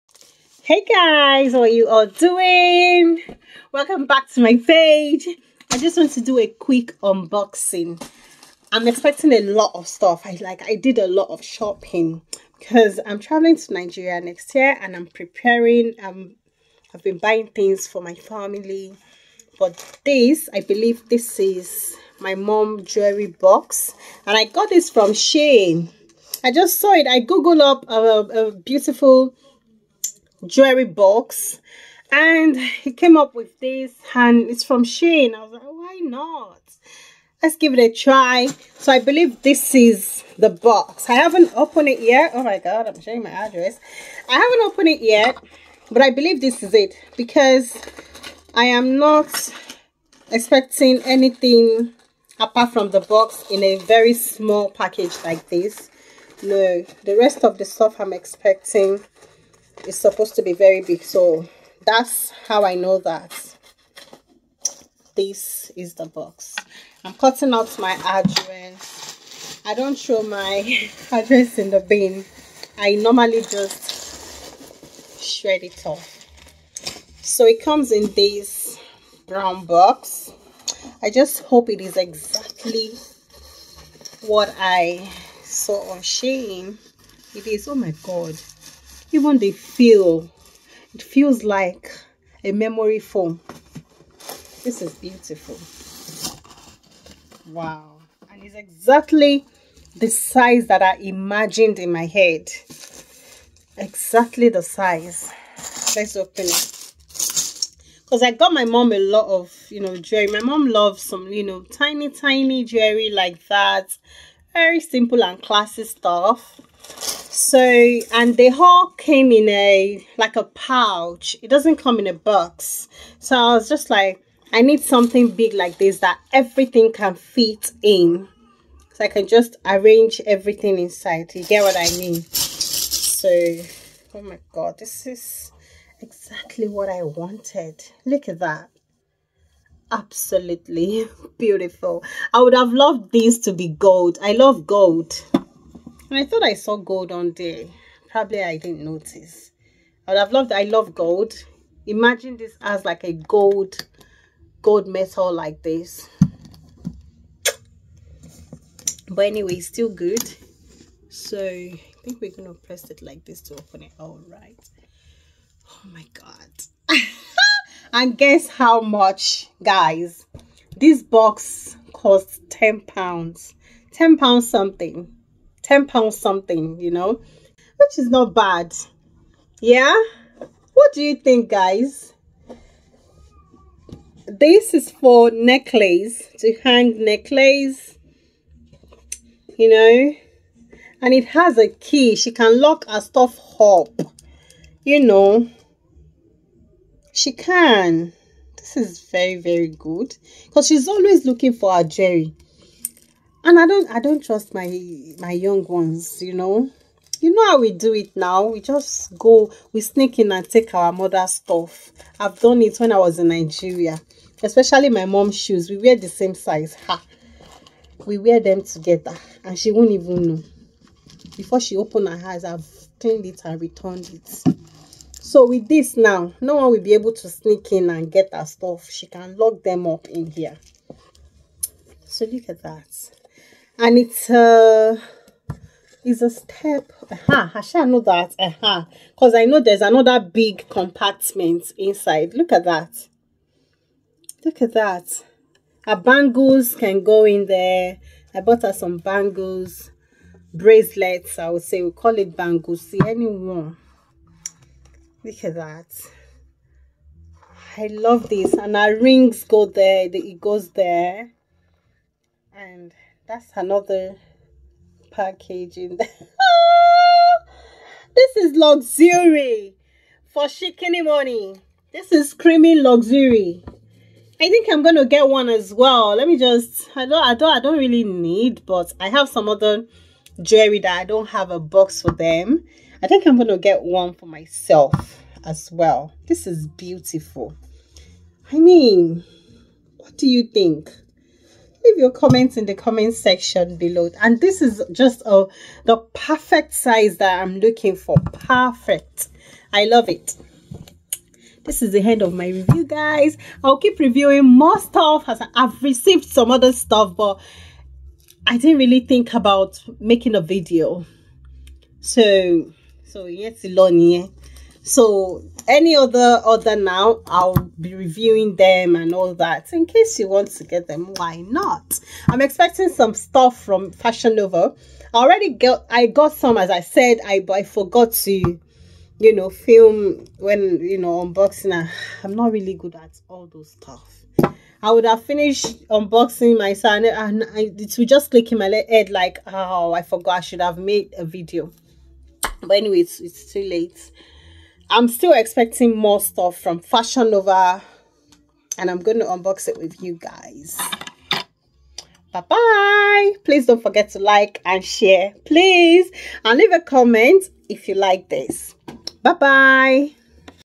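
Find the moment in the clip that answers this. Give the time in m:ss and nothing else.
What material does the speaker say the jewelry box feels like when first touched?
1:32.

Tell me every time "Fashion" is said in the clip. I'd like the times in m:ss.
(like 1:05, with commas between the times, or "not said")
5:23, 5:46.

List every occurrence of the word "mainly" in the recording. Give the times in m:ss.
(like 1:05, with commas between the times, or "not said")
not said.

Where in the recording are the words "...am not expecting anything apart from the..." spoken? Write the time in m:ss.
0:48.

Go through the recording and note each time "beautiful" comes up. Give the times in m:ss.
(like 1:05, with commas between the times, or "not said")
0:28, 1:34, 2:21, 4:46.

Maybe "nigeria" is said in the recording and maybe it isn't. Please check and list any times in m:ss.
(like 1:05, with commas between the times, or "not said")
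0:13, 3:33.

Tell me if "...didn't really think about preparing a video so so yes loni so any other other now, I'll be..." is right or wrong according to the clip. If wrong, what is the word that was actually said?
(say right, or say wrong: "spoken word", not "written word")
wrong: "making", not "preparing".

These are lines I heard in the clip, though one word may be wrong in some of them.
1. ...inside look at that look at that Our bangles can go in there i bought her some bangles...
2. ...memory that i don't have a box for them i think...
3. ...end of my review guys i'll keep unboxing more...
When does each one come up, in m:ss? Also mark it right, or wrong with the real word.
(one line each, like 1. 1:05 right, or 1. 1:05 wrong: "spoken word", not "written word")
1. 4:01 right
2. 4:40 wrong: "jewelry", not "memory"
3. 5:02 wrong: "reviewing", not "unboxing".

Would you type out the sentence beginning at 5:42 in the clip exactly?
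But anyway, it's, it's too late.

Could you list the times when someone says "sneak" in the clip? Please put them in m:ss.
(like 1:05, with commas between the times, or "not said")
3:29, 3:47.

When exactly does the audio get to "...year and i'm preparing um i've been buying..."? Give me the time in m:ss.
0:14.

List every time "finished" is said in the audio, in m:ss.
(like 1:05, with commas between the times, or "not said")
5:35.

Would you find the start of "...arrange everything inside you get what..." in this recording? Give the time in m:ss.
2:09.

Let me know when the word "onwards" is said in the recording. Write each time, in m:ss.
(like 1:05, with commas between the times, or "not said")
not said.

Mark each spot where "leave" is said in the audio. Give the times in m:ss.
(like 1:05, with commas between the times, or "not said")
4:51, 5:56.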